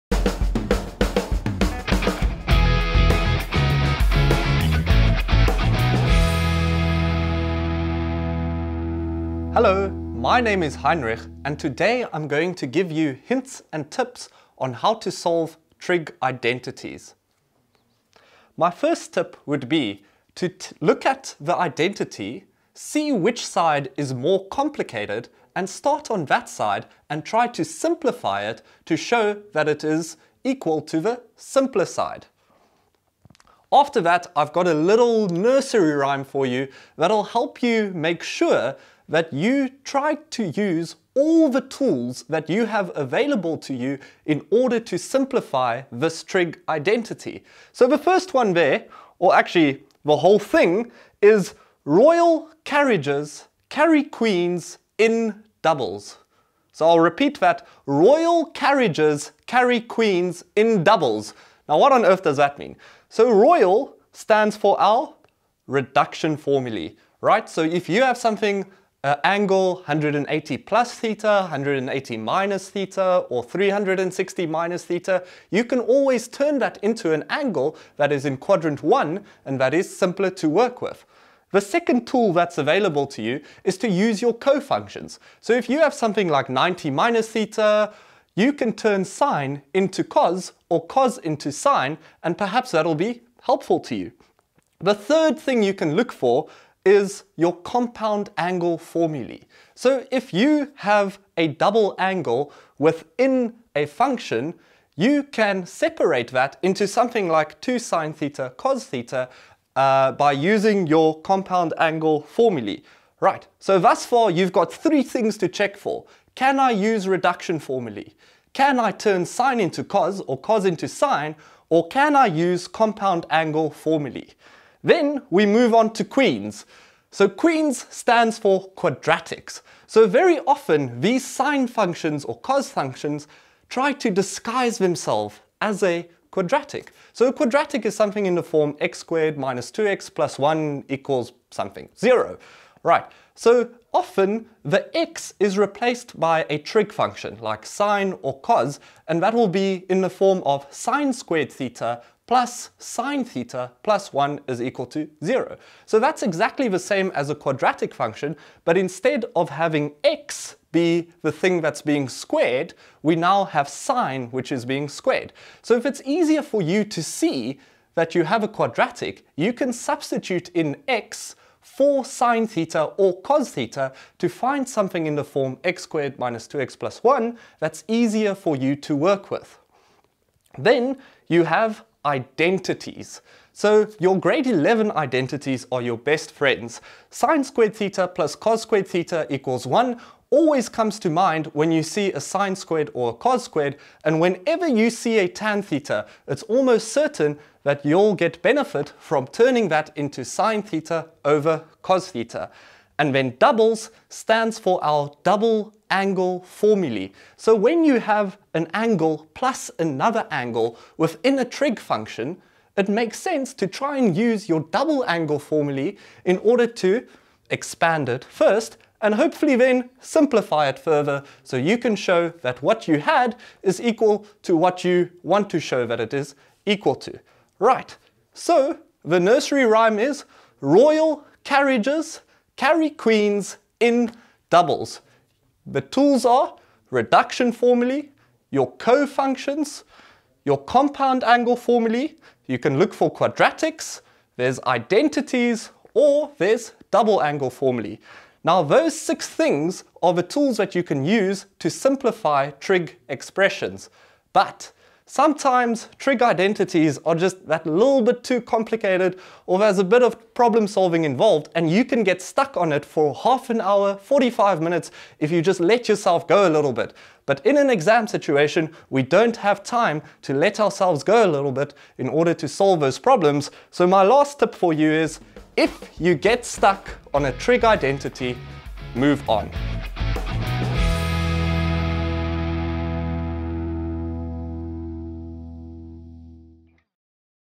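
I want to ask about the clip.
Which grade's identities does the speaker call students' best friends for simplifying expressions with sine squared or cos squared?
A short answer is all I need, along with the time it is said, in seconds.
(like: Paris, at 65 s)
Grade 11, at 184 s.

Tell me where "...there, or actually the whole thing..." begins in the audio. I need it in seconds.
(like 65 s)
48 s.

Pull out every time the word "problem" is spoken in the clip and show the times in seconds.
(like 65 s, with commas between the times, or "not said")
260 s, 272 s.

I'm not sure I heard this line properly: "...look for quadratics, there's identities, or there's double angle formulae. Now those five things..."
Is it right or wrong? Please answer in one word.
wrong.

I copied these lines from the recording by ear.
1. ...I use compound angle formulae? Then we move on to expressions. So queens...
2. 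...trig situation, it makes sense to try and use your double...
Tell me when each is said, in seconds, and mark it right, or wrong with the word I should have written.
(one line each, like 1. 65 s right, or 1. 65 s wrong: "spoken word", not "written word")
1. 122 s wrong: "queens", not "expressions"
2. 211 s wrong: "function", not "situation".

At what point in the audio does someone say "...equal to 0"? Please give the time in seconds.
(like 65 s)
154 s.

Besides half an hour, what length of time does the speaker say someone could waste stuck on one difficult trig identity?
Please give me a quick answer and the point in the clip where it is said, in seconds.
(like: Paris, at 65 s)
45 minutes, at 263 s.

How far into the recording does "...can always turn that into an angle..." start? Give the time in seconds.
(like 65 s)
75 s.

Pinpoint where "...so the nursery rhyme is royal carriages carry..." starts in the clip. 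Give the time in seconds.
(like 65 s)
228 s.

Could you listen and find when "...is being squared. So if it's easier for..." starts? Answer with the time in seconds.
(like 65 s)
164 s.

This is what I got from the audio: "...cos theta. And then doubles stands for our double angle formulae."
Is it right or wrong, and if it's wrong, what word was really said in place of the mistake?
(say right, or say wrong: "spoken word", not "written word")
right.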